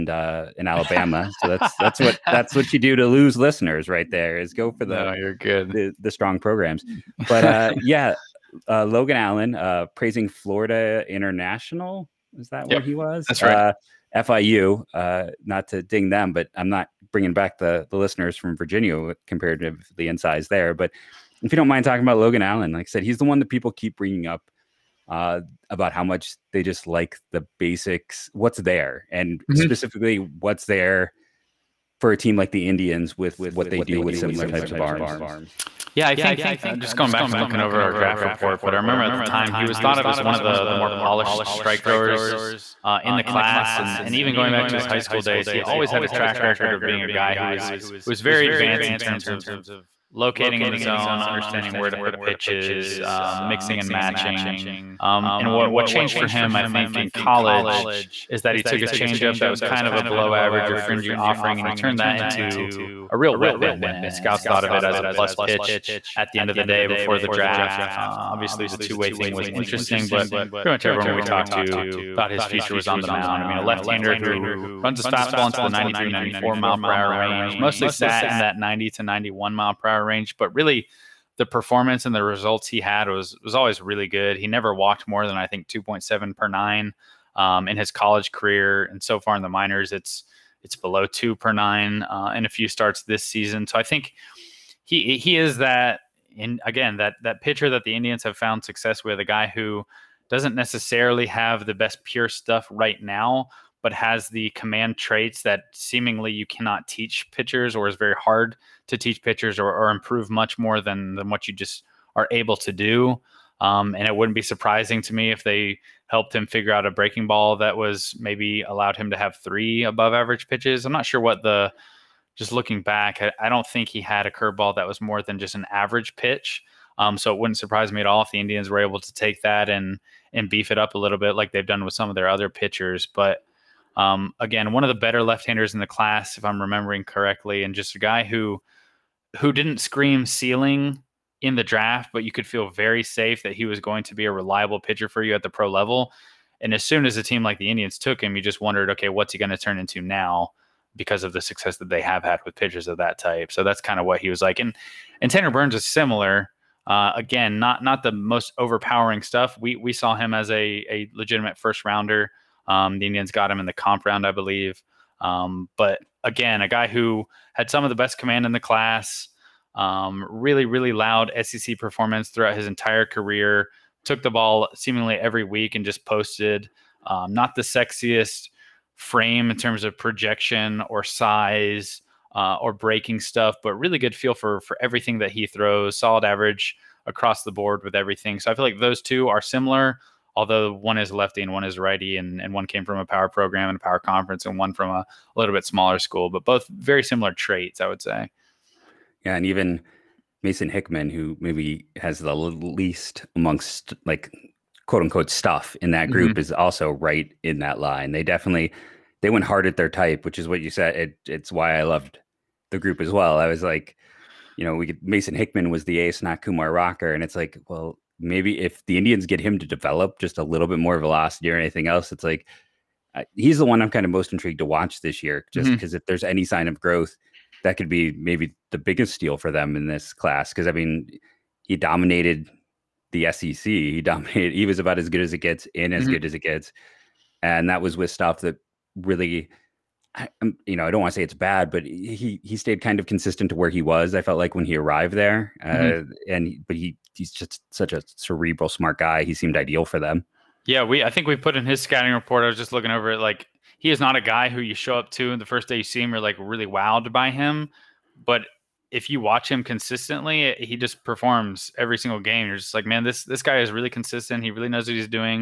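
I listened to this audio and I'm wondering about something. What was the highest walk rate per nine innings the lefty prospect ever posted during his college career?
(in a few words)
2.7.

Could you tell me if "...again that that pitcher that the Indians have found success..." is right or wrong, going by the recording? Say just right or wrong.
right.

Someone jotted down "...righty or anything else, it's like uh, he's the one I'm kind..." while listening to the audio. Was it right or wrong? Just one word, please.
wrong.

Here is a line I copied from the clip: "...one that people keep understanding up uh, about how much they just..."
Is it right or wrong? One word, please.
wrong.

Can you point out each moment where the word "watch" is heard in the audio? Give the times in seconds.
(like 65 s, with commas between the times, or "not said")
224 s, 259 s.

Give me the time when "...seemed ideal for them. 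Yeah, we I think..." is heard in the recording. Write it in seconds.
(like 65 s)
249 s.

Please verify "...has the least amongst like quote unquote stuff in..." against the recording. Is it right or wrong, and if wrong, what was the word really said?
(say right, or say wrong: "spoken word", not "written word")
right.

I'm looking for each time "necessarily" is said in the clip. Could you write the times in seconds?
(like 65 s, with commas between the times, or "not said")
100 s.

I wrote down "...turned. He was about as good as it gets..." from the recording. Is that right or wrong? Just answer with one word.
wrong.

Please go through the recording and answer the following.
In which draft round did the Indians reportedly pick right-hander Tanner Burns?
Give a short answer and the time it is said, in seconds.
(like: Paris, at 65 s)
comp round, at 163 s.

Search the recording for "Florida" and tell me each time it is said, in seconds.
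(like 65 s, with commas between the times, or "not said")
10 s.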